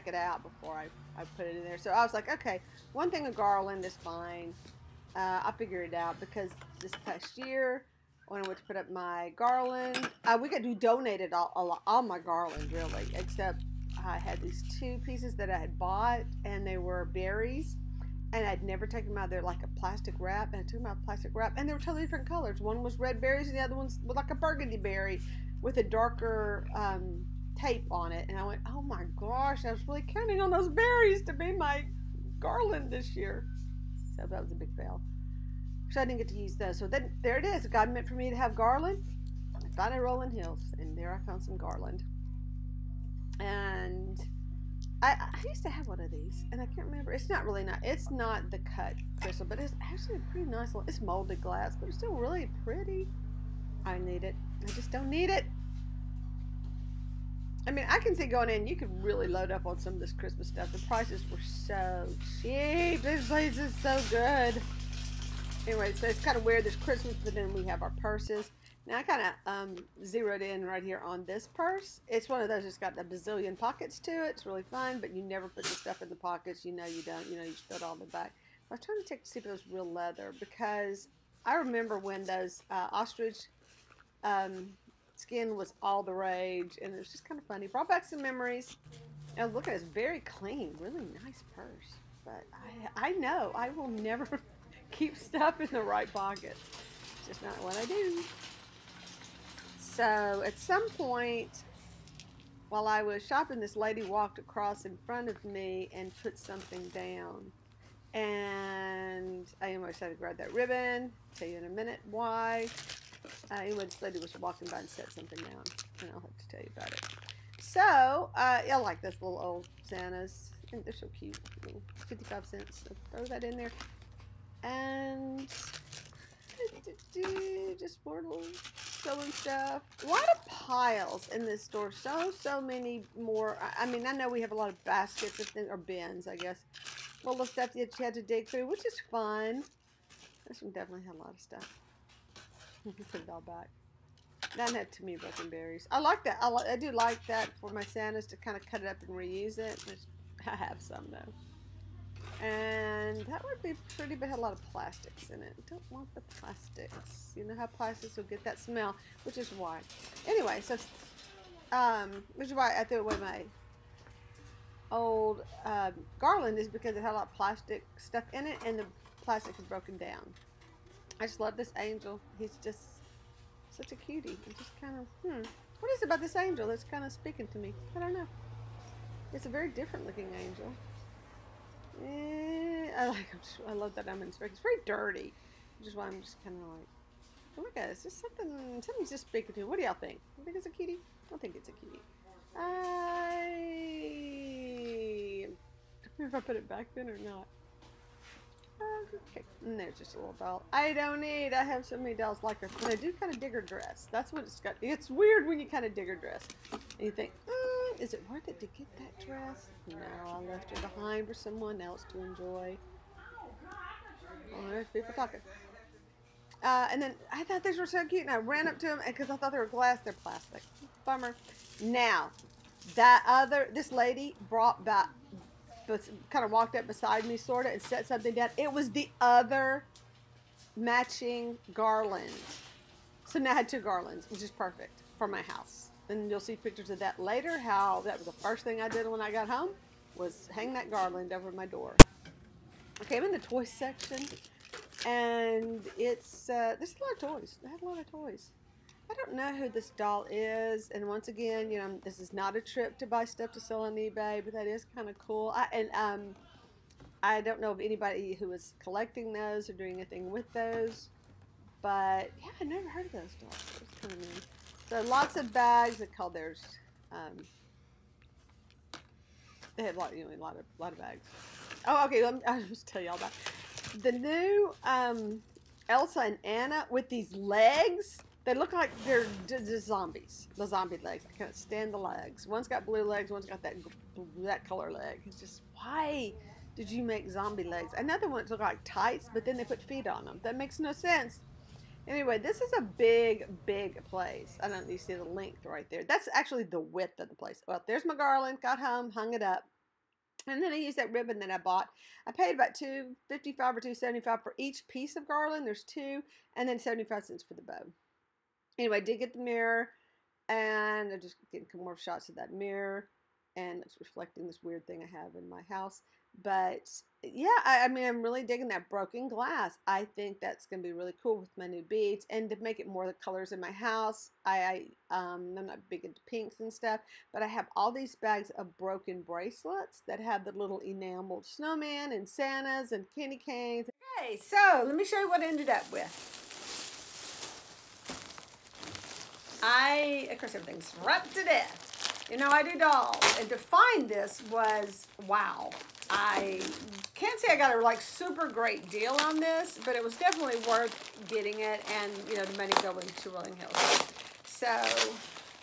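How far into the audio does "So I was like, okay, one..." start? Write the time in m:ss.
0:01.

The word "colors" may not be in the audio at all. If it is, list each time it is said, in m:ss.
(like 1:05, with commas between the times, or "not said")
0:22, 4:26, 4:44, 5:23.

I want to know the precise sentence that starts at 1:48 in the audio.
And I almost had to grab that ribbon.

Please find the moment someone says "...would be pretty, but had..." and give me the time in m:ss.
2:33.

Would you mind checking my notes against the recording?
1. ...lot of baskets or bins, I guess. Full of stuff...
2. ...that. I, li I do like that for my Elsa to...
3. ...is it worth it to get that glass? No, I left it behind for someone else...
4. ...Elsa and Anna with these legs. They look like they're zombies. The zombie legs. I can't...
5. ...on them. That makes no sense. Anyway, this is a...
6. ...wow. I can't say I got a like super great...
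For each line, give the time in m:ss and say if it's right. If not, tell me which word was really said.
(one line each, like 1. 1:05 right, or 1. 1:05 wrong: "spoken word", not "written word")
1. 2:14 right
2. 2:26 wrong: "Santas", not "Elsa"
3. 3:27 wrong: "dress", not "glass"
4. 4:35 right
5. 4:50 right
6. 5:45 right.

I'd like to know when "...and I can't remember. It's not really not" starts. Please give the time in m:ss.
0:46.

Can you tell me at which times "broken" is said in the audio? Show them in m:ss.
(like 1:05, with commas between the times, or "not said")
2:25, 2:49, 5:18, 5:28.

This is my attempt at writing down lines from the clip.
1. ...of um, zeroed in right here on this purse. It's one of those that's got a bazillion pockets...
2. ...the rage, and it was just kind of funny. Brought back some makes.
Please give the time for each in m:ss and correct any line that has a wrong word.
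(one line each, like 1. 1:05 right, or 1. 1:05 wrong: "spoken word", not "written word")
1. 1:09 right
2. 1:26 wrong: "memories", not "makes".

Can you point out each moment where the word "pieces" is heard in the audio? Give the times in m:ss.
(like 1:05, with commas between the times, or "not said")
0:14, 5:04.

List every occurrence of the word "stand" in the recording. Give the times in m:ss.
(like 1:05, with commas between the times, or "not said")
4:41.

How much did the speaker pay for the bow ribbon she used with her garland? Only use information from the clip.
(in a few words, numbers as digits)
75 cents.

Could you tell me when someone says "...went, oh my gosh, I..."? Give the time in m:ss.
0:28.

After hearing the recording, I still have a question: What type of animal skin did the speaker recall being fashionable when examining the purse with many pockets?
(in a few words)
Ostrich.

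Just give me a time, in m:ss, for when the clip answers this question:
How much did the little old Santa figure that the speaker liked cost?
2:02.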